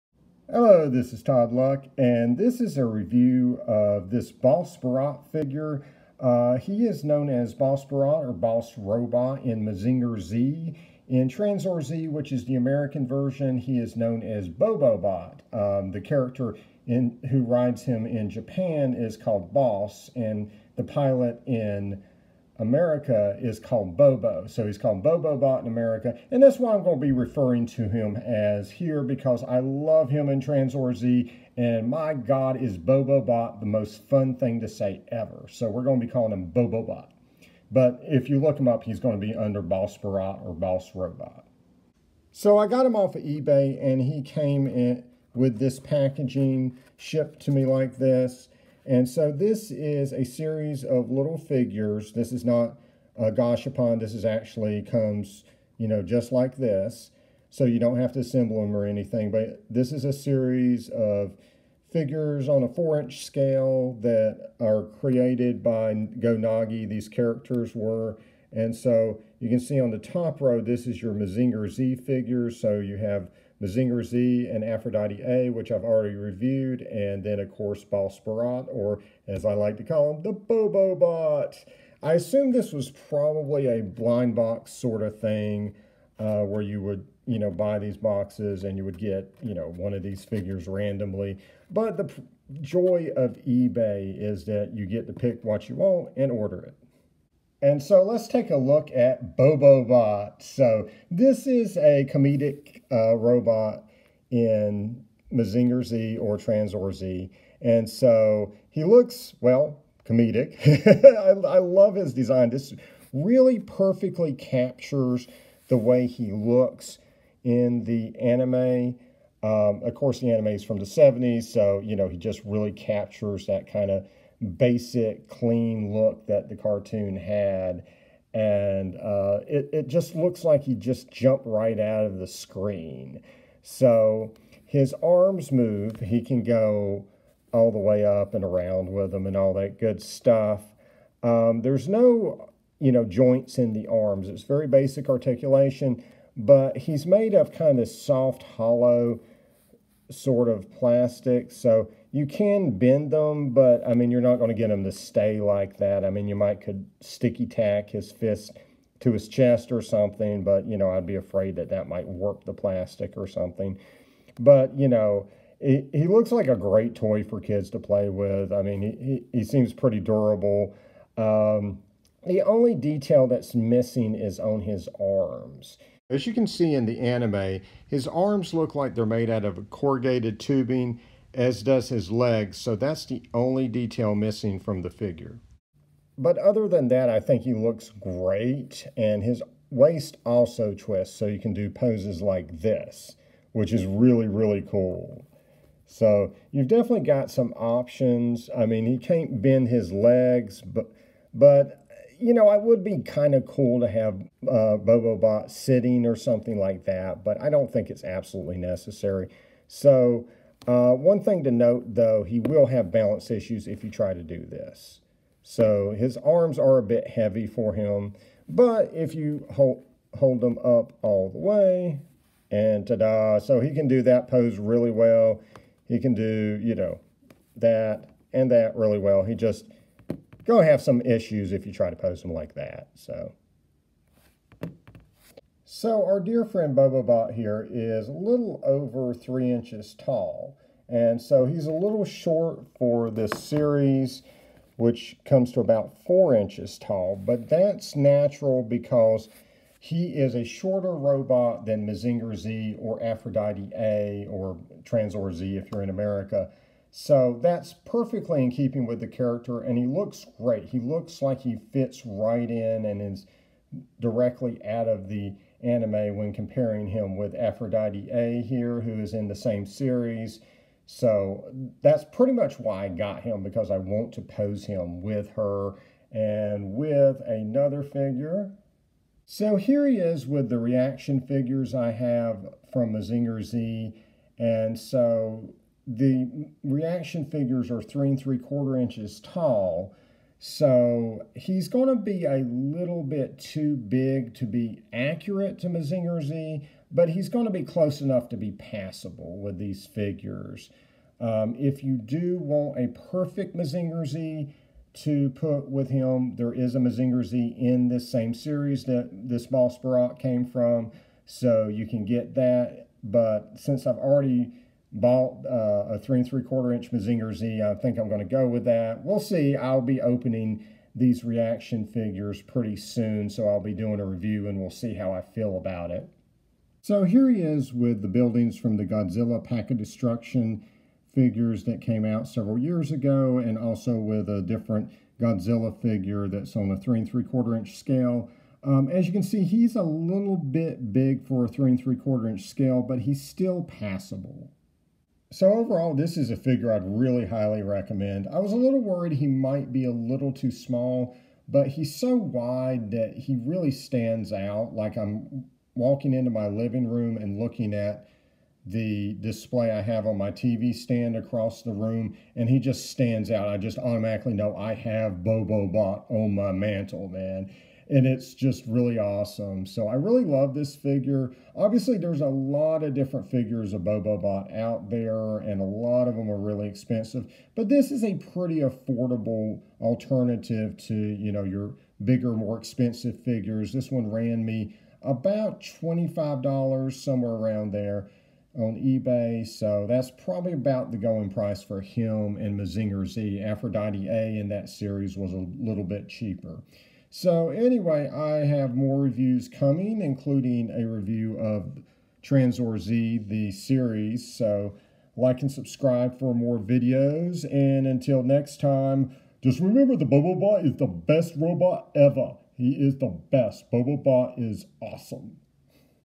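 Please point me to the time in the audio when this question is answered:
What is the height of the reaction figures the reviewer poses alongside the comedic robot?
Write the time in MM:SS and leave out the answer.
04:47.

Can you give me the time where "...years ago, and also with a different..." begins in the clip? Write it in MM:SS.
05:32.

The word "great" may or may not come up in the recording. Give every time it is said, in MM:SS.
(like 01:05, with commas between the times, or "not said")
02:46, 03:08, 04:20.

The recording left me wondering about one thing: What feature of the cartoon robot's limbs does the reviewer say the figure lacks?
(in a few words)
corrugated tubing.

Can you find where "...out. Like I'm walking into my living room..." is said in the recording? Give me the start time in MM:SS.
05:54.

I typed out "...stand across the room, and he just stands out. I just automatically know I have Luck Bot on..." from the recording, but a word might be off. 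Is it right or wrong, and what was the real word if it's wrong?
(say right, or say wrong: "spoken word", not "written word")
wrong: "Bobo", not "Luck".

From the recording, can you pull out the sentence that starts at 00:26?
And that's why I'm going to be referring to him as here because I love him in Tranzor Z.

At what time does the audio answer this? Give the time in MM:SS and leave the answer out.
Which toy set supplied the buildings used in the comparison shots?
05:28.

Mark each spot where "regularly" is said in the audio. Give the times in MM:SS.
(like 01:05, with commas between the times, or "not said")
not said.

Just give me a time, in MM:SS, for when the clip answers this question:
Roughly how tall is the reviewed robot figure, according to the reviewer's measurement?
03:58.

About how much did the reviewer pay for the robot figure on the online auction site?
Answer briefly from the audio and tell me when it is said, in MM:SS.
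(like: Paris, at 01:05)
$25, at 06:25.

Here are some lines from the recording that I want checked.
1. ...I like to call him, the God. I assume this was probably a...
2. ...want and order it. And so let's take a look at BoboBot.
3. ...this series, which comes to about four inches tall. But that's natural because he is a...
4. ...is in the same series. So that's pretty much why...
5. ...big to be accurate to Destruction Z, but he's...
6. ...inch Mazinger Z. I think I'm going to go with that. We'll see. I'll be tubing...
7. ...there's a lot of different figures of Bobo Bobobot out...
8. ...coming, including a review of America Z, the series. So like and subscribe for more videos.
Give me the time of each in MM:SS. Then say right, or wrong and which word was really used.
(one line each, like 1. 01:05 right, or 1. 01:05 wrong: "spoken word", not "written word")
1. 01:19 wrong: "Bobobot", not "God"
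2. 01:35 right
3. 04:03 right
4. 04:28 right
5. 04:53 wrong: "Mazinger", not "Destruction"
6. 05:16 wrong: "opening", not "tubing"
7. 06:11 wrong: "Bot", not "Bobobot"
8. 06:39 wrong: "Tranzor", not "America".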